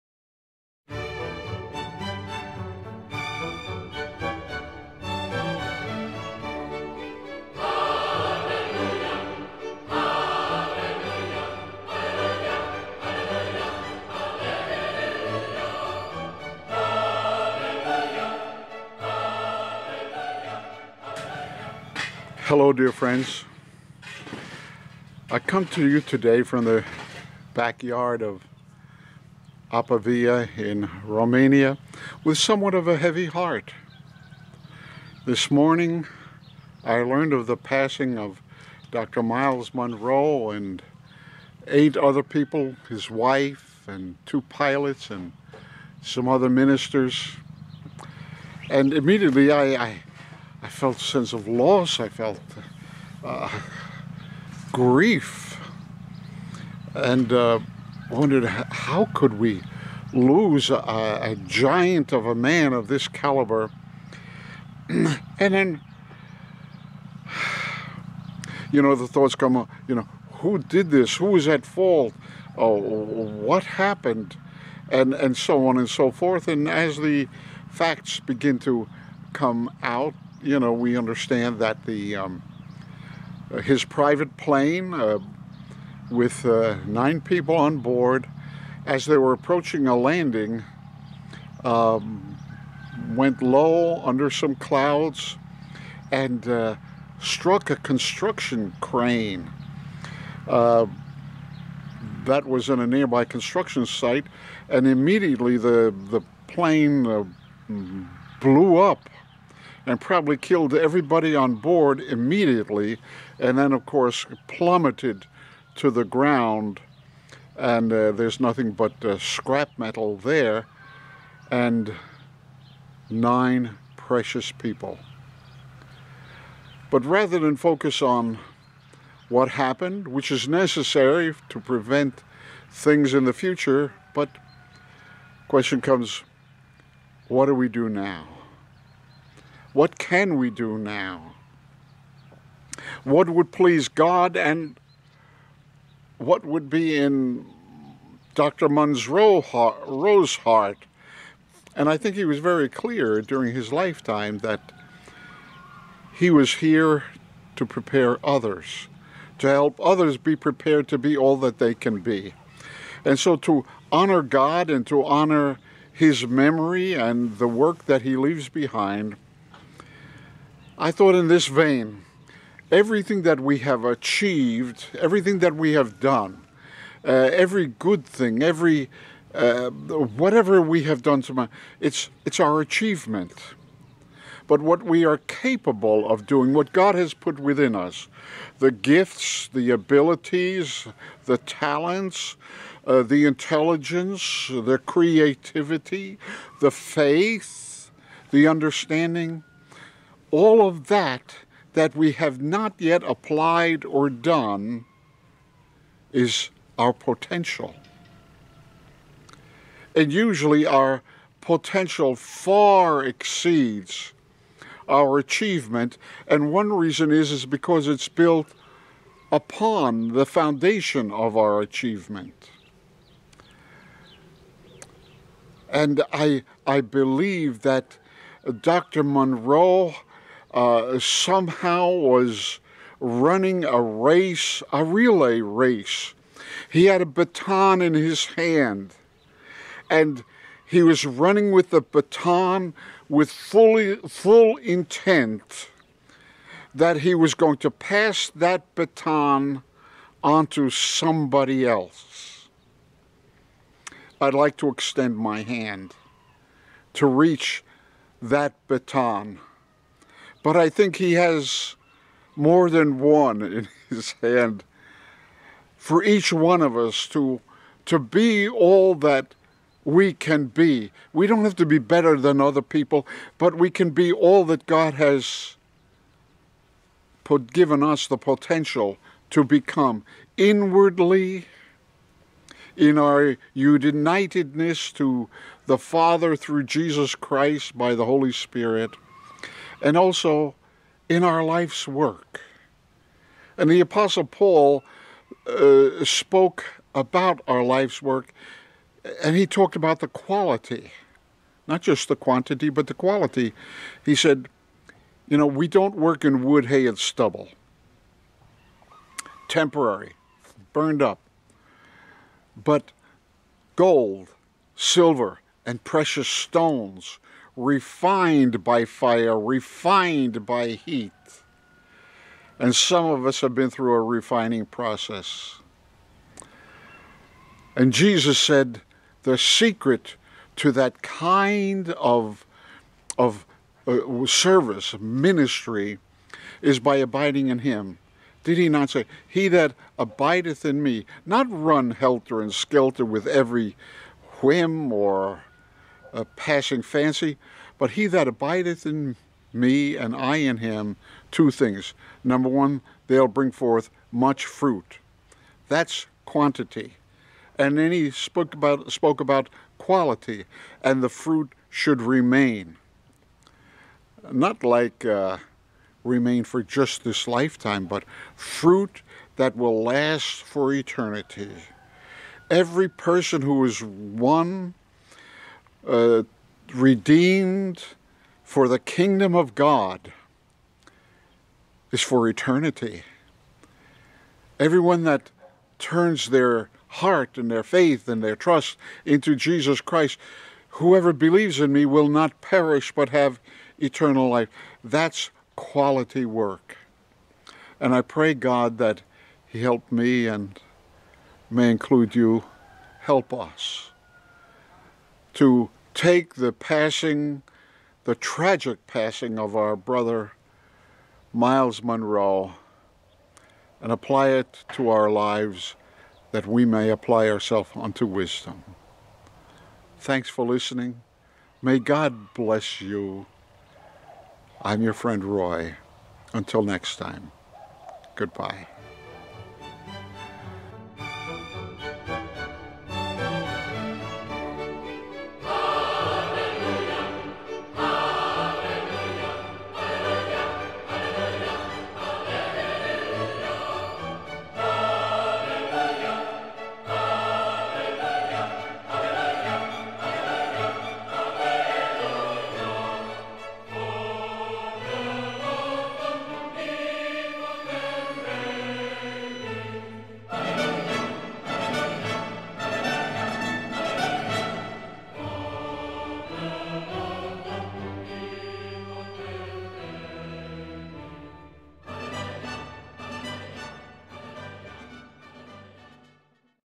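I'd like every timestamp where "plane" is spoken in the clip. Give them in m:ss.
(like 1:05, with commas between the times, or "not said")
1:24, 1:46.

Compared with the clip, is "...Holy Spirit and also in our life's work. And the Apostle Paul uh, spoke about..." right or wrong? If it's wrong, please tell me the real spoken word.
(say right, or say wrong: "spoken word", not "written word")
right.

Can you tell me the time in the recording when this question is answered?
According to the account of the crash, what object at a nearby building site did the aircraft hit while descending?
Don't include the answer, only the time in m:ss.
1:37.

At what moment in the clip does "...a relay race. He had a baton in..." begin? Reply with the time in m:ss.
3:54.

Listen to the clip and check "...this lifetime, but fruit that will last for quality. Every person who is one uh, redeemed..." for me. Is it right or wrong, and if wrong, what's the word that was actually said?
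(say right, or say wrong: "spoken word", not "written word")
wrong: "eternity", not "quality".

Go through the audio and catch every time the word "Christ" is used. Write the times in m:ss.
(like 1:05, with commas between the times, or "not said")
4:47, 6:29.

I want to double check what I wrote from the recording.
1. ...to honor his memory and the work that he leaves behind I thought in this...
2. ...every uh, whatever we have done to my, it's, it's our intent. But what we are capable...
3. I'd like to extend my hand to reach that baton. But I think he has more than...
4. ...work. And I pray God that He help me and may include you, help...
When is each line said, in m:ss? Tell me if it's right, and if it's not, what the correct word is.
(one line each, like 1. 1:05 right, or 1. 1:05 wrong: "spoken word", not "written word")
1. 2:44 right
2. 2:58 wrong: "achievement", not "intent"
3. 4:14 right
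4. 6:36 right.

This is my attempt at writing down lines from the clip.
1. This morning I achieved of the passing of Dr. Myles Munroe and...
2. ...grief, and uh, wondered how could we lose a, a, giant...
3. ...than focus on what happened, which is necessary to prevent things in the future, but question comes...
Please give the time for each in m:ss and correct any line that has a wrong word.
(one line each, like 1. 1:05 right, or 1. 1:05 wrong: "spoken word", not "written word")
1. 0:35 wrong: "learned", not "achieved"
2. 0:54 right
3. 2:07 right.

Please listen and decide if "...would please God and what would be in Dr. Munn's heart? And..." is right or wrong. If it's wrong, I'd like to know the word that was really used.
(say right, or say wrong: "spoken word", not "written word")
right.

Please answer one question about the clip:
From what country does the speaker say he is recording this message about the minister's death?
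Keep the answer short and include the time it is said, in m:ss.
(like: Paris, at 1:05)
Romania, at 0:31.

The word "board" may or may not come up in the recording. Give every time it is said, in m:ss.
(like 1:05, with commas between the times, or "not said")
1:27, 1:51.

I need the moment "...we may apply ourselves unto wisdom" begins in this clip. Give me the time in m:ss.
6:56.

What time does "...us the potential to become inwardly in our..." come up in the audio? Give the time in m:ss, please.
4:37.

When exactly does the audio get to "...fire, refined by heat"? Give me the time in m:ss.
5:18.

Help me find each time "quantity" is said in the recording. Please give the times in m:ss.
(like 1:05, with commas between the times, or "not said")
5:02, 5:56.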